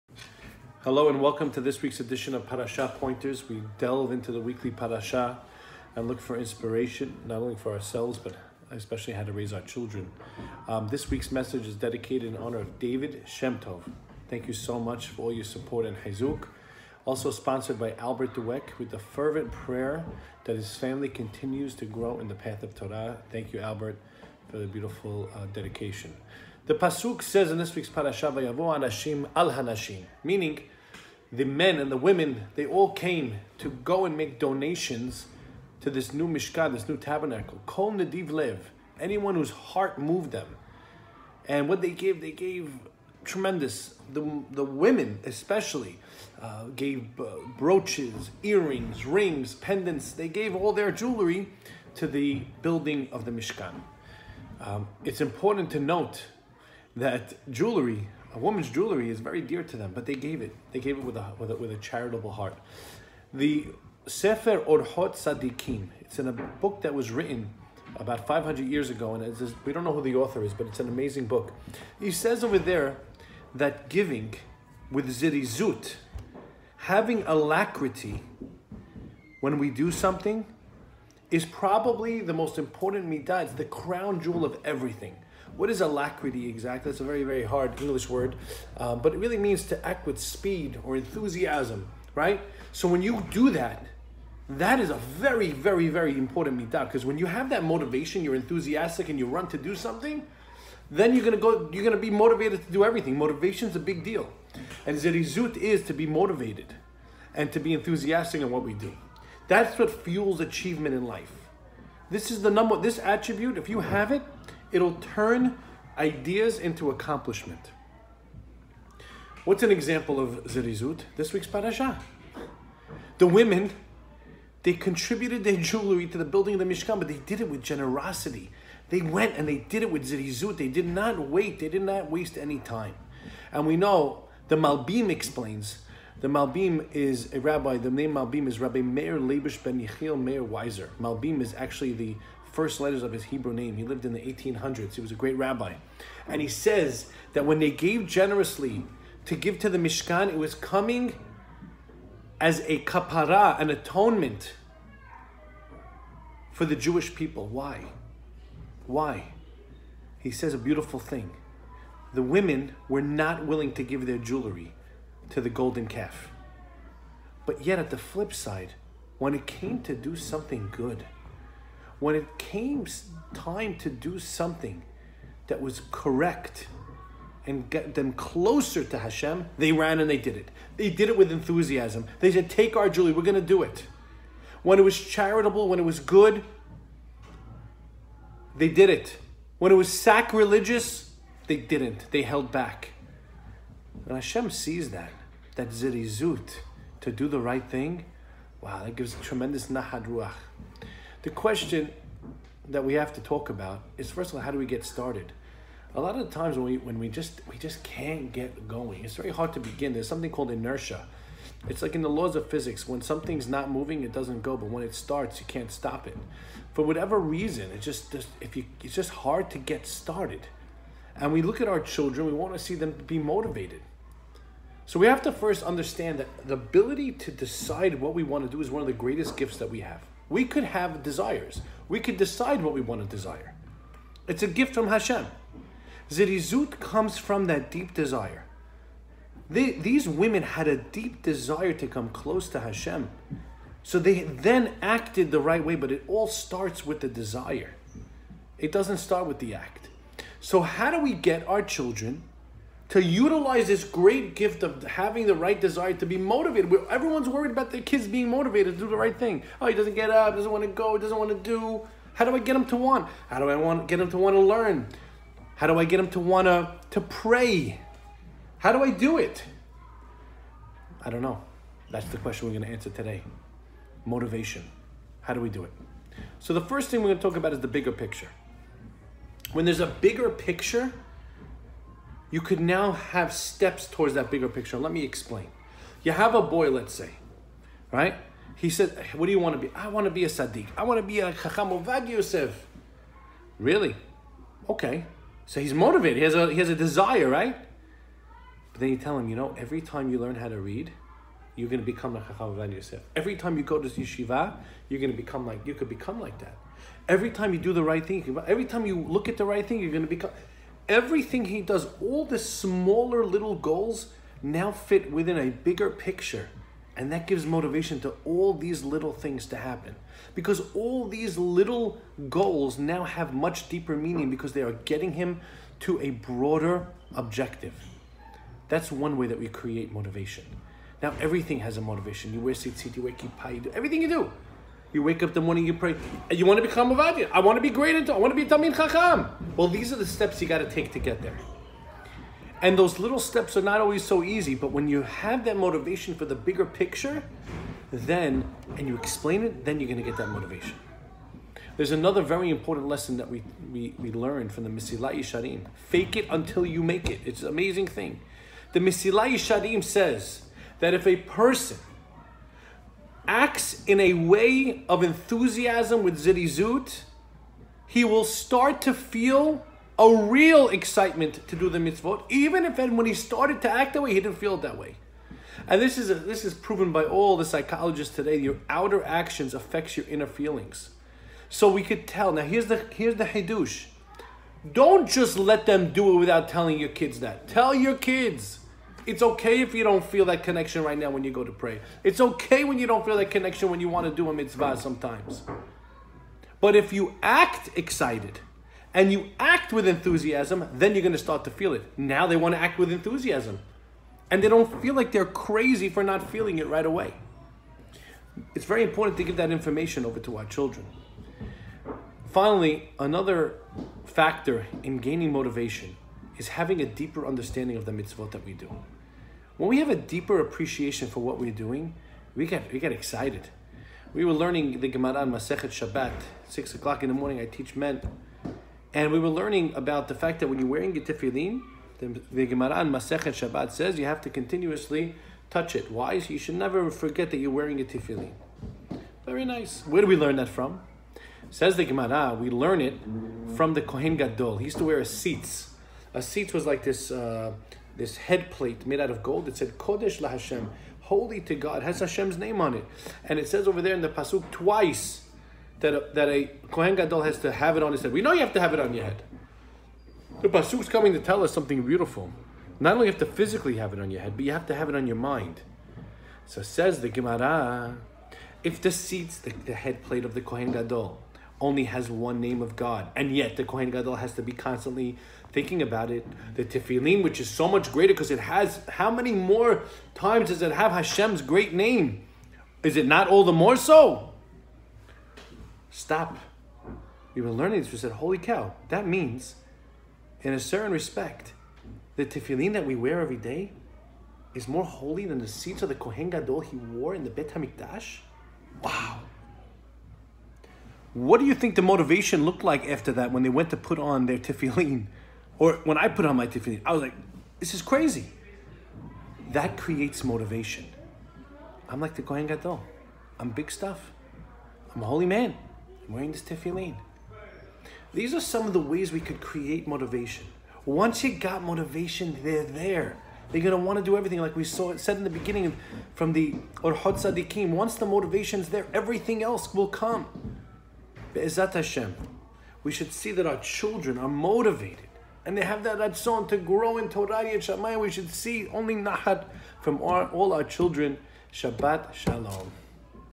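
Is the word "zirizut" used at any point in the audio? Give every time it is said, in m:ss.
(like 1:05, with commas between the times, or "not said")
1:15, 3:15, 3:56.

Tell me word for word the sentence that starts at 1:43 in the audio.
Motivation's a big deal, and zerizut is to be motivated and to be enthusiastic in what we do.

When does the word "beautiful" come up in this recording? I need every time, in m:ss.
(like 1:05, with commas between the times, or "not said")
0:24, 2:40, 7:41.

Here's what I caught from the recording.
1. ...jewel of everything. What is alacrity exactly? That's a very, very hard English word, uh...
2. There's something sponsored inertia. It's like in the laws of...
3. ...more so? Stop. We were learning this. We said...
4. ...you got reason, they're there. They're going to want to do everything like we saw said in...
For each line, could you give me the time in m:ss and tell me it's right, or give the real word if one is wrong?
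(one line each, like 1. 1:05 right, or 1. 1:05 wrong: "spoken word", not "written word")
1. 1:24 right
2. 3:29 wrong: "called", not "sponsored"
3. 8:03 right
4. 8:41 wrong: "motivation", not "reason".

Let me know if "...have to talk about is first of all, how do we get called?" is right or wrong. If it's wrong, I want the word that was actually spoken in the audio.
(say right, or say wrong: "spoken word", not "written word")
wrong: "started", not "called".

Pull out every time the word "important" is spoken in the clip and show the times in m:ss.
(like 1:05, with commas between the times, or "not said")
0:55, 1:22, 1:36, 5:52, 6:48.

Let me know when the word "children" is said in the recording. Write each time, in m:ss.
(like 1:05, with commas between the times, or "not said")
0:09, 3:41, 4:11, 6:50, 8:53, 9:00.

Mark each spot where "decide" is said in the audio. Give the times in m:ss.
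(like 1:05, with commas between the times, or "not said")
3:47, 3:52.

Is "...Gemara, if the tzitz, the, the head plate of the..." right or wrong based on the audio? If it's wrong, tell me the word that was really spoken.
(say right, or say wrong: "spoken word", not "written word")
right.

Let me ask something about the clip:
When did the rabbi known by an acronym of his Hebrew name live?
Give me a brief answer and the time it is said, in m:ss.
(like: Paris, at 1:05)
1800s, at 2:24.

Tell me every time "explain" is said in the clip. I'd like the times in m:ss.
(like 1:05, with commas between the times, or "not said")
2:15, 4:45, 5:48.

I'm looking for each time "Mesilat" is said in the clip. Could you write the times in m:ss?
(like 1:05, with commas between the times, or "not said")
5:54, 5:58.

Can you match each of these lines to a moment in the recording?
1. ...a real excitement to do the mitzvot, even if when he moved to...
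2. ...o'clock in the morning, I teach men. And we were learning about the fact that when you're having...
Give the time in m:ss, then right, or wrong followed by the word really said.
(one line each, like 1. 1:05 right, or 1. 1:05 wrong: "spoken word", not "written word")
1. 6:09 wrong: "started", not "moved"
2. 7:06 wrong: "wearing", not "having".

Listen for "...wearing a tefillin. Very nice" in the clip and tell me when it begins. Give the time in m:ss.
7:17.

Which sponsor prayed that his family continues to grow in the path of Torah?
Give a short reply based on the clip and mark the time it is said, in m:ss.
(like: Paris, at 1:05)
Albert Dweck, at 0:17.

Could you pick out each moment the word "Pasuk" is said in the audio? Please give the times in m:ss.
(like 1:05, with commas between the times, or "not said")
0:26, 7:34, 7:40.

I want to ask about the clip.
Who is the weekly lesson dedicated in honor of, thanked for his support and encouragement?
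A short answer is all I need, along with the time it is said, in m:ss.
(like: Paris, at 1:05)
David Chemtob, at 0:12.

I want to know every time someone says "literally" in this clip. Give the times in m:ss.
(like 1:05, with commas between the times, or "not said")
not said.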